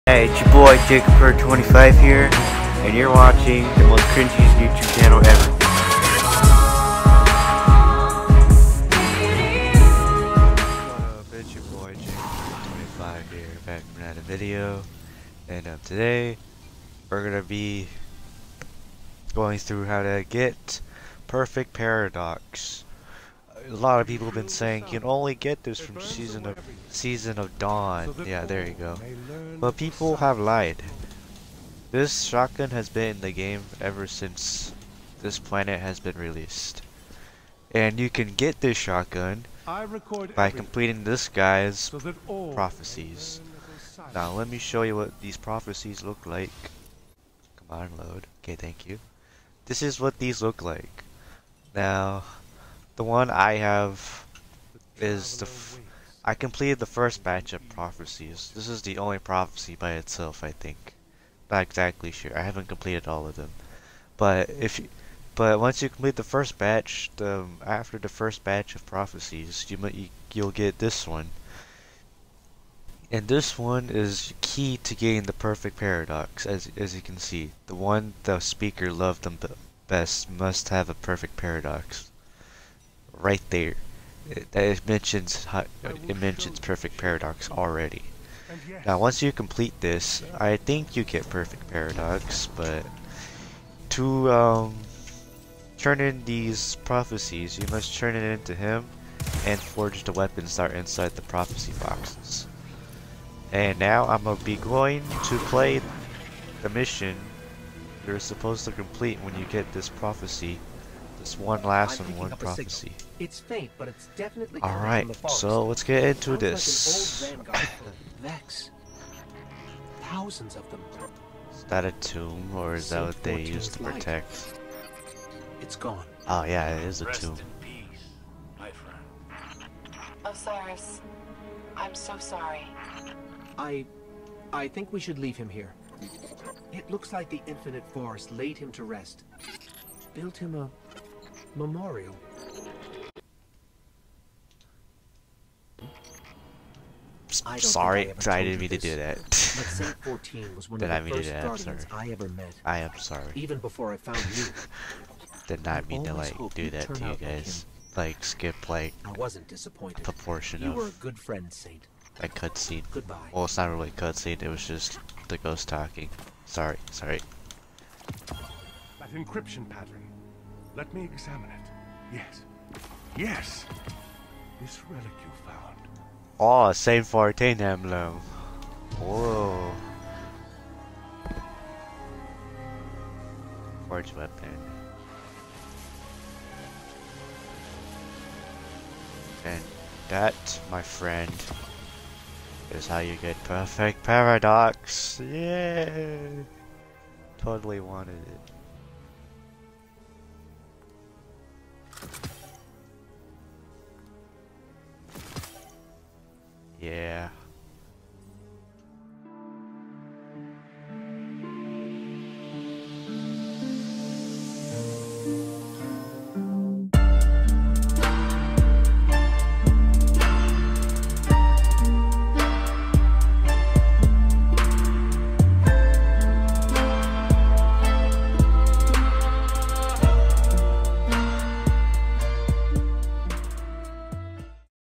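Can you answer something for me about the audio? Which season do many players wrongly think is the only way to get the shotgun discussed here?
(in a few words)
Season of Dawn.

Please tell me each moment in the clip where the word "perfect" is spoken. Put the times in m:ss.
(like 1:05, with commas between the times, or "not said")
0:21, 1:15, 1:20, 1:26, 1:31, 3:13.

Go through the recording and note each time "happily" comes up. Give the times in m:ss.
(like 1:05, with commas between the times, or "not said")
not said.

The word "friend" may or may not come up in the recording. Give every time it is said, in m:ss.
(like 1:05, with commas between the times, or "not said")
2:41, 3:10.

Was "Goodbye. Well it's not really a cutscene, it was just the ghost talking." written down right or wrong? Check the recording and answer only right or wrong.
right.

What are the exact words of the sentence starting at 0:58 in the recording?
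This is the only prophecy by itself, I think.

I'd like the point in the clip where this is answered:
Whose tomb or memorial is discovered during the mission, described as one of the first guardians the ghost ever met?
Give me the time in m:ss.
2:29.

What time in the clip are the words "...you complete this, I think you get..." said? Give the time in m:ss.
1:29.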